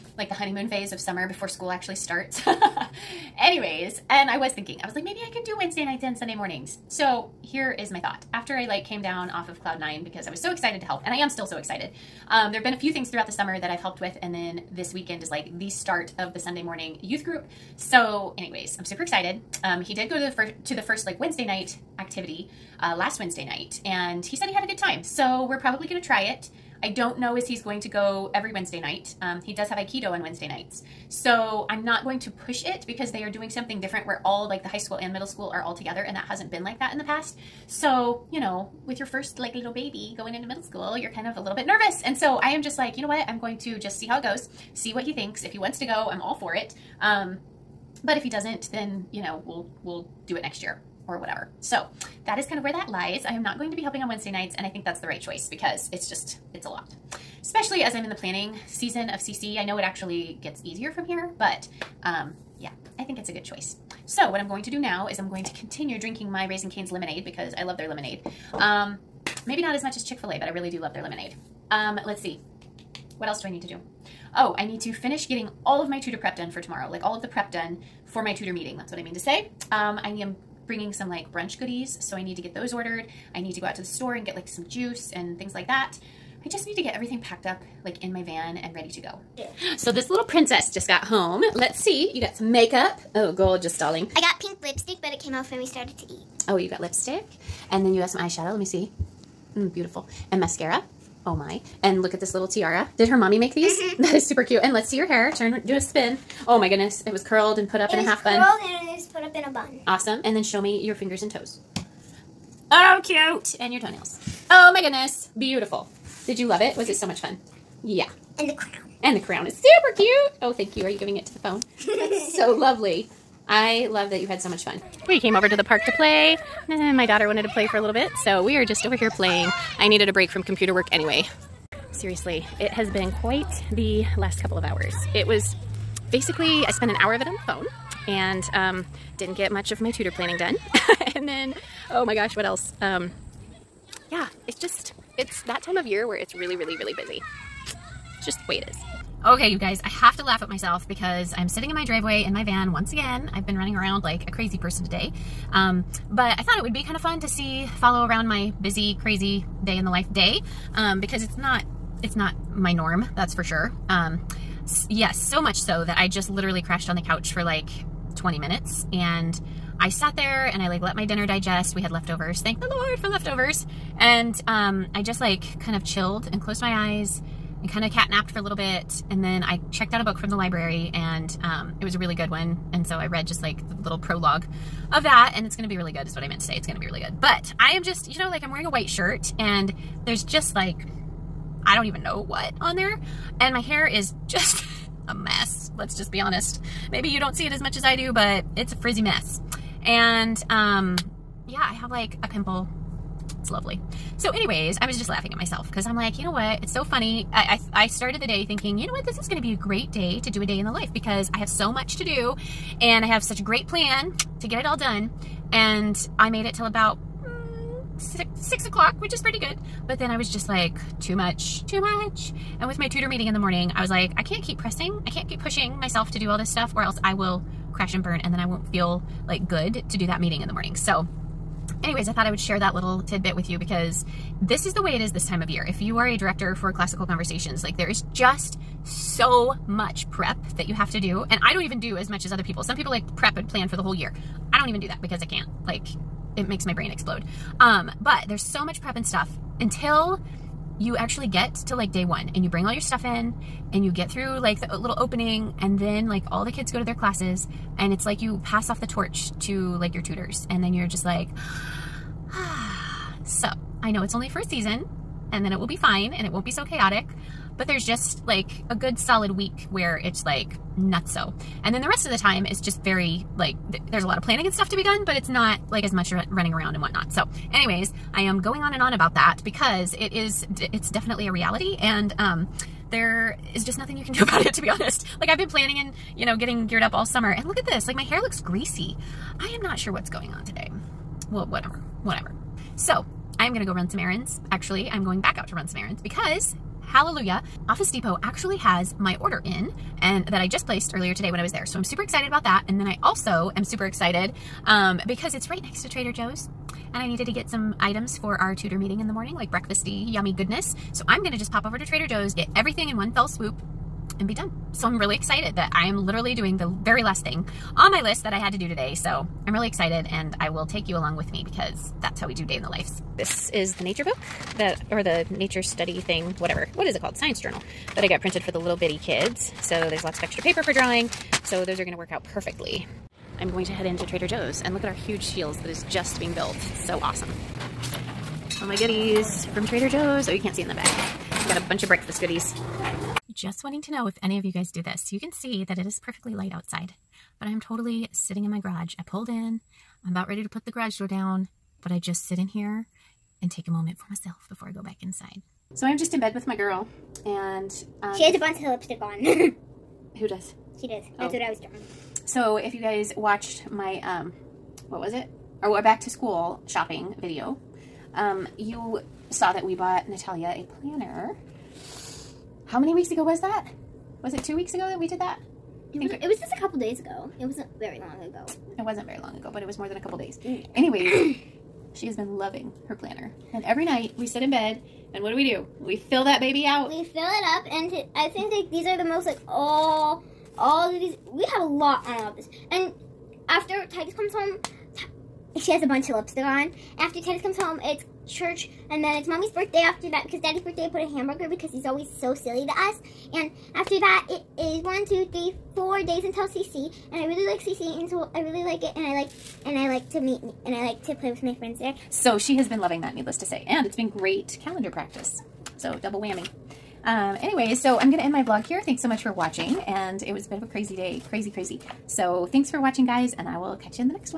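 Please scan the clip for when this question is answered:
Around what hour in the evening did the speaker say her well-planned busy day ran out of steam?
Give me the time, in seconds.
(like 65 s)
218 s.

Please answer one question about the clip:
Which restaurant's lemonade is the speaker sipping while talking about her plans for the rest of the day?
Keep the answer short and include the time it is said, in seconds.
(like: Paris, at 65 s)
Raising Cane's, at 66 s.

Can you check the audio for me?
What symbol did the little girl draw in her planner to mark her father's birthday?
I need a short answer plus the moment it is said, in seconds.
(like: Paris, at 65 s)
a hamburger, at 401 s.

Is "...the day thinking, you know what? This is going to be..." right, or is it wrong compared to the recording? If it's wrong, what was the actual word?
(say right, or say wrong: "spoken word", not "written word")
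right.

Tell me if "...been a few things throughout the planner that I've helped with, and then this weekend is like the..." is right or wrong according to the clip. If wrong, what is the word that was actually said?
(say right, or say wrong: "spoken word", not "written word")
wrong: "summer", not "planner".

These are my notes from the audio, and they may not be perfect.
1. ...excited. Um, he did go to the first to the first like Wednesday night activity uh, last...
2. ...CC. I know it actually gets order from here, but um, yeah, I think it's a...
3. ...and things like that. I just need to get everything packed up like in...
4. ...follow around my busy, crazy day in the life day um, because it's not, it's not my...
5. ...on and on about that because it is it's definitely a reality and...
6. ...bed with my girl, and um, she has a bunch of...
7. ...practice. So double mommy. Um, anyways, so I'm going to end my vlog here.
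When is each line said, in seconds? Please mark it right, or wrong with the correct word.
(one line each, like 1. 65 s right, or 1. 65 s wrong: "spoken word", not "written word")
1. 19 s right
2. 59 s wrong: "easier", not "order"
3. 85 s right
4. 157 s right
5. 278 s right
6. 356 s right
7. 414 s wrong: "whammy", not "mommy".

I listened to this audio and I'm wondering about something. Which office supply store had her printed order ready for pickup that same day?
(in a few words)
Office Depot.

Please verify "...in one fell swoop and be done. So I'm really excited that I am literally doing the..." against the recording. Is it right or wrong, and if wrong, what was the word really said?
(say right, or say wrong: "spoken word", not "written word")
right.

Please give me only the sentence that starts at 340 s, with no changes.
Oh, you can't see in the back.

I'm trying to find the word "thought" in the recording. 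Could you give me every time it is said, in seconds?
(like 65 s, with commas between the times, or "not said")
7 s, 156 s, 232 s.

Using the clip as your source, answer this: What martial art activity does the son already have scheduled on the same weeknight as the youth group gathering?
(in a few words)
Aikido.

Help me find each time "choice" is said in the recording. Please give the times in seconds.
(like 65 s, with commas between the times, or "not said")
55 s, 63 s.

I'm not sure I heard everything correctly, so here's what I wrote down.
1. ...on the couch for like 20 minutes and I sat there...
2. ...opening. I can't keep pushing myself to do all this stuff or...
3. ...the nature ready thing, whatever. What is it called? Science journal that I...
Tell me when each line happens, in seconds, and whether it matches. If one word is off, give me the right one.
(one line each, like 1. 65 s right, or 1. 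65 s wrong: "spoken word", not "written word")
1. 166 s right
2. 224 s wrong: "pressing", not "opening"
3. 325 s wrong: "study", not "ready".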